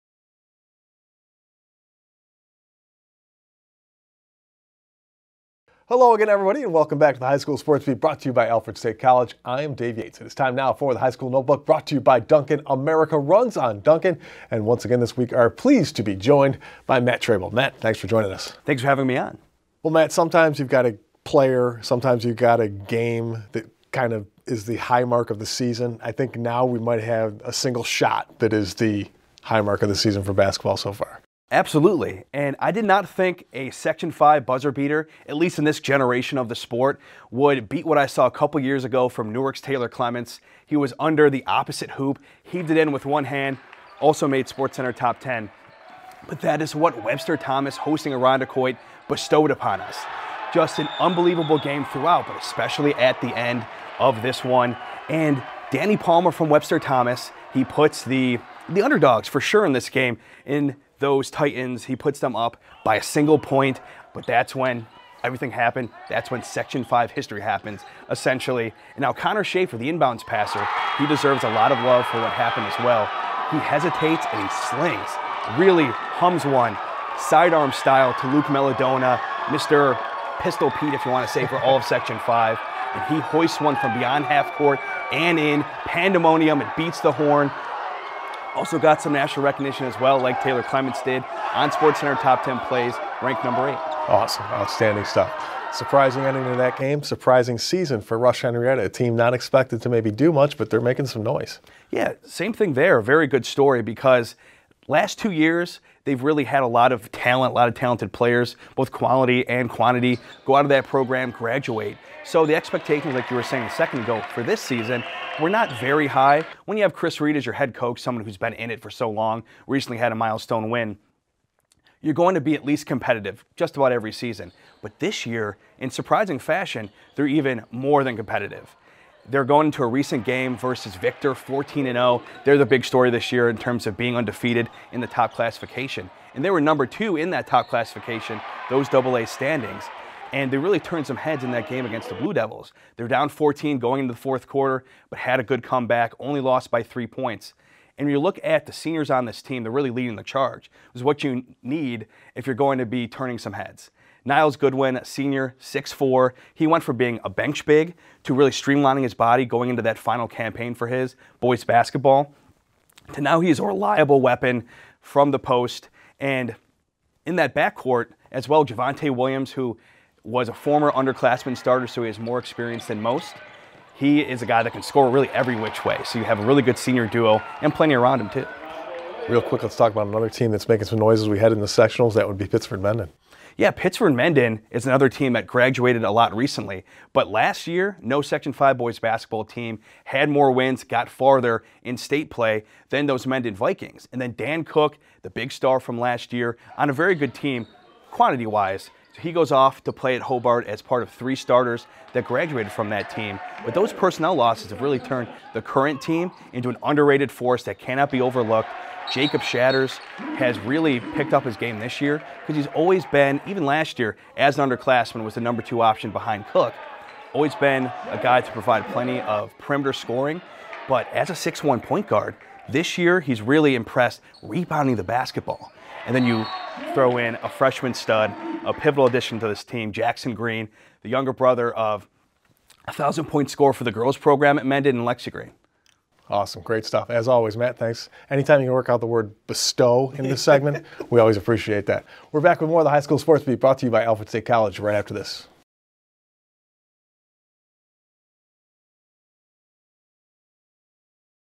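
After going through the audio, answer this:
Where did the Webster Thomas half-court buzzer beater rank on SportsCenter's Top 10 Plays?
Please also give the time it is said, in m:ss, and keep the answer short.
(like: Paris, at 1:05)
8, at 1:33.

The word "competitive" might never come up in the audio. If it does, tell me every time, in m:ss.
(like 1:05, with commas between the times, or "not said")
2:02, 2:08.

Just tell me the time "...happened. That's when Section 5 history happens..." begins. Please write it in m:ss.
1:05.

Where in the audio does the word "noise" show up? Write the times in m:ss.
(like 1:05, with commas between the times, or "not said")
1:41, 3:00.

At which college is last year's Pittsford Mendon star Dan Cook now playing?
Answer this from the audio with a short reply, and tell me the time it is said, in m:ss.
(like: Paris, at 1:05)
Hobart, at 3:20.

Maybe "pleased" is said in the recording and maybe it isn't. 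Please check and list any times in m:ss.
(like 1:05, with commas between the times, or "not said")
0:15.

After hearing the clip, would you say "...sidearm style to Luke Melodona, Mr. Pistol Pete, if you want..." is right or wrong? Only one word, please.
right.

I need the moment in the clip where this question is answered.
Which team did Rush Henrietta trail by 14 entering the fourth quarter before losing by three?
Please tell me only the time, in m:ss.
2:10.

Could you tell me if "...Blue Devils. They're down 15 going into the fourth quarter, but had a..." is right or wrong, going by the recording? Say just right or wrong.
wrong.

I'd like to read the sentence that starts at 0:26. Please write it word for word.
I think now we might have a single shot that is the high mark of the season for basketball so far.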